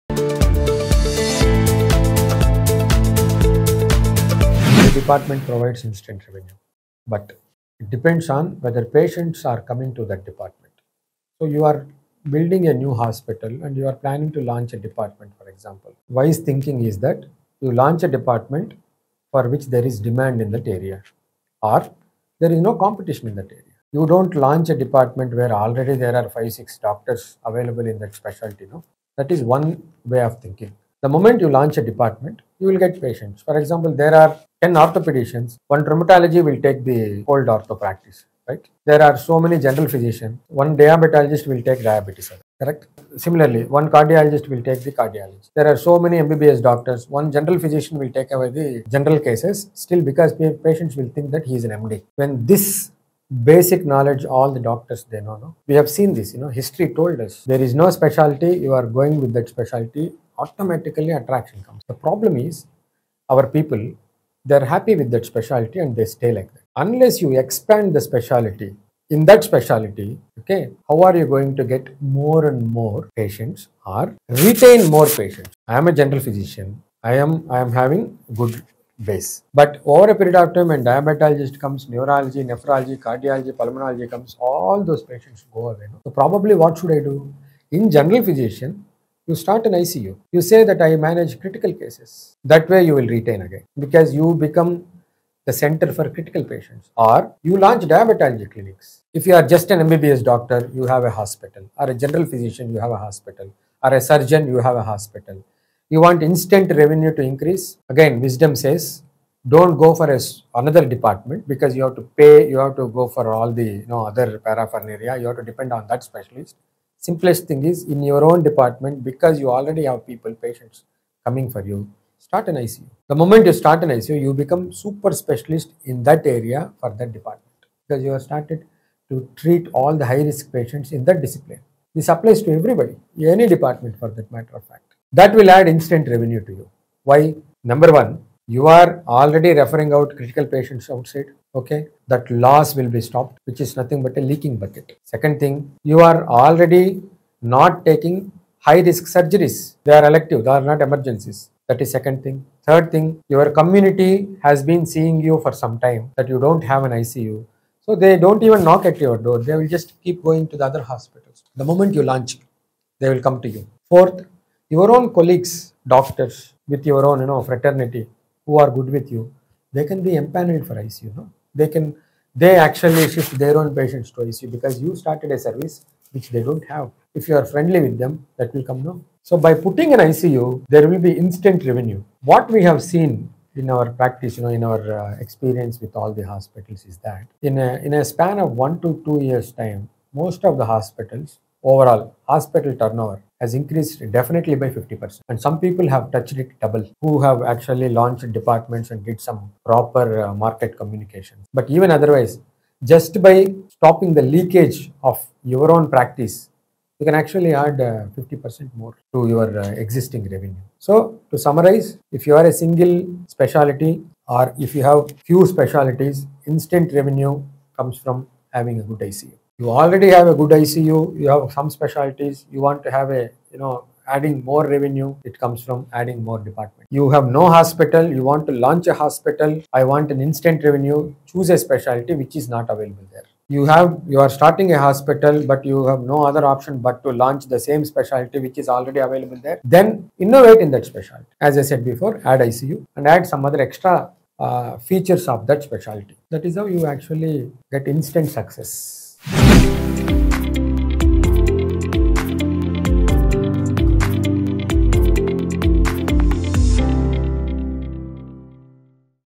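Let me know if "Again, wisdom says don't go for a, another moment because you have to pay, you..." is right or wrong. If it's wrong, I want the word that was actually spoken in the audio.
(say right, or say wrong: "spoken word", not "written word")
wrong: "department", not "moment".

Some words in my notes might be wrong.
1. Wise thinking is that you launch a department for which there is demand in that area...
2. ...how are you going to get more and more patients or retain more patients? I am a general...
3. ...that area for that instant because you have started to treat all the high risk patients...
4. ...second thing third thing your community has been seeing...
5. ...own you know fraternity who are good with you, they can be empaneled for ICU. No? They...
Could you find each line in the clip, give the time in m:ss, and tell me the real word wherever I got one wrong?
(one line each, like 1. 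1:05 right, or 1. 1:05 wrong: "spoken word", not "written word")
1. 0:16 right
2. 1:10 right
3. 2:06 wrong: "department", not "instant"
4. 2:31 right
5. 2:47 right.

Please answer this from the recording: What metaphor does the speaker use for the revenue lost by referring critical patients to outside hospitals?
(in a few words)
leaking bucket.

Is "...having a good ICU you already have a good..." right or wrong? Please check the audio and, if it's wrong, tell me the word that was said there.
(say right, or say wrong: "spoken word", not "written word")
right.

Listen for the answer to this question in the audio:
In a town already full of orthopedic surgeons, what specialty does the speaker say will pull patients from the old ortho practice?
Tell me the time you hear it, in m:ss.
0:35.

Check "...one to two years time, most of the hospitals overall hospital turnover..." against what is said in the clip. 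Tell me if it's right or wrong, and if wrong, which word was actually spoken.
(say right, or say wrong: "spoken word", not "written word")
right.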